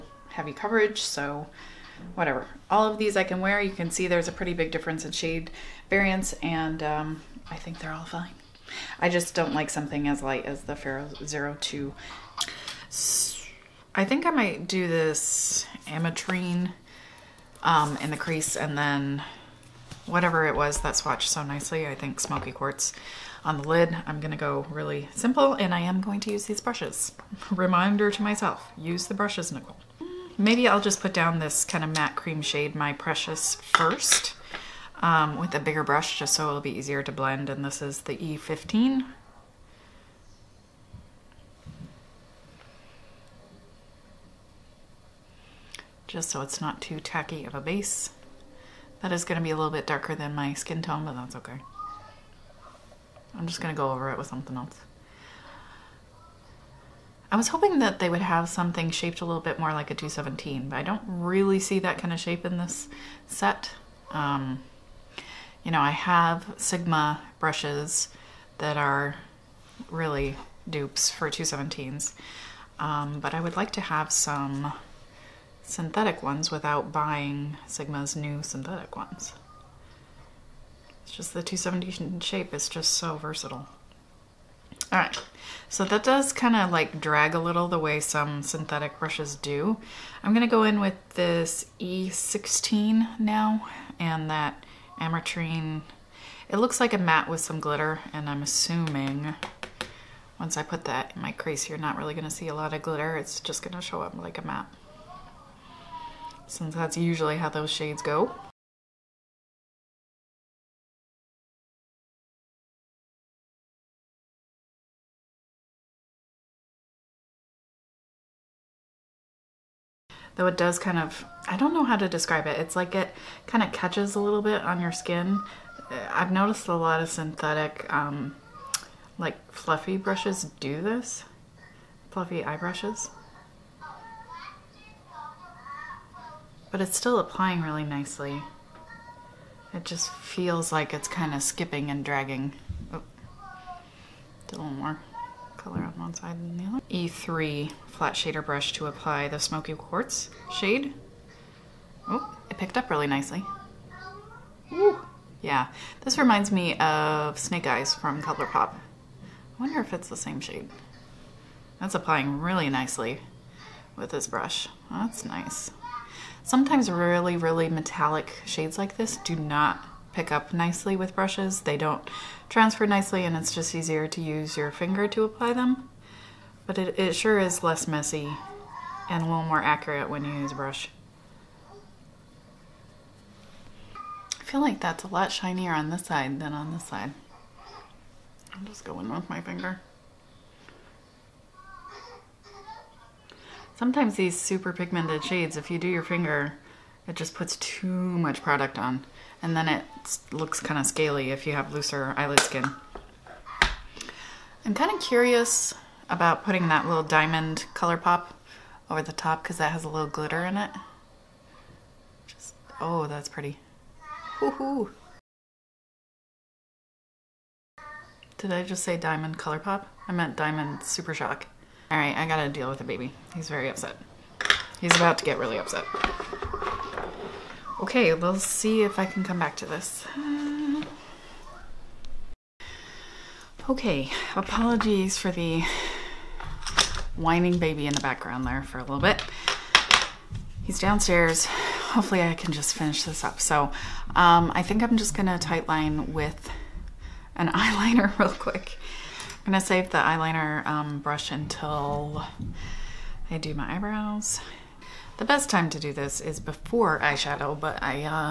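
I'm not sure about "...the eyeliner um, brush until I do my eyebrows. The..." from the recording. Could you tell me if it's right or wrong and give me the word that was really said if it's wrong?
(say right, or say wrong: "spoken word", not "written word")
right.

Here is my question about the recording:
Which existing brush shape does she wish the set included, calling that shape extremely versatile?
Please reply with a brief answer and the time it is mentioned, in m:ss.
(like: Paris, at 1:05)
217, at 0:59.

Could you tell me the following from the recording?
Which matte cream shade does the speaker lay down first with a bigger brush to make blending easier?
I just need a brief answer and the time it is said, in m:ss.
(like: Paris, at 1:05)
My Precious, at 0:32.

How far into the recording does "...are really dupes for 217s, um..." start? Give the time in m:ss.
1:08.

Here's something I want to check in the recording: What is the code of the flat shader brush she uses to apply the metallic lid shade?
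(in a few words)
E3.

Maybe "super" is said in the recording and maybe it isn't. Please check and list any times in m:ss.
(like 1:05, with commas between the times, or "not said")
3:14, 3:40.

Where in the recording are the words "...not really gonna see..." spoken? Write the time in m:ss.
1:41.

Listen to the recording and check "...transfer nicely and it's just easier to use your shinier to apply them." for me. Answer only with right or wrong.
wrong.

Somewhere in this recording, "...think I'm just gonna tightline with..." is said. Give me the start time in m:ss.
4:04.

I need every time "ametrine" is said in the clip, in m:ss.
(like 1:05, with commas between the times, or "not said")
0:15, 1:35.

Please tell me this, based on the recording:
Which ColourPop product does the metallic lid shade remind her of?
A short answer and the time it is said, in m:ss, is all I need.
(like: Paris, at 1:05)
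Snake Eyes, at 2:37.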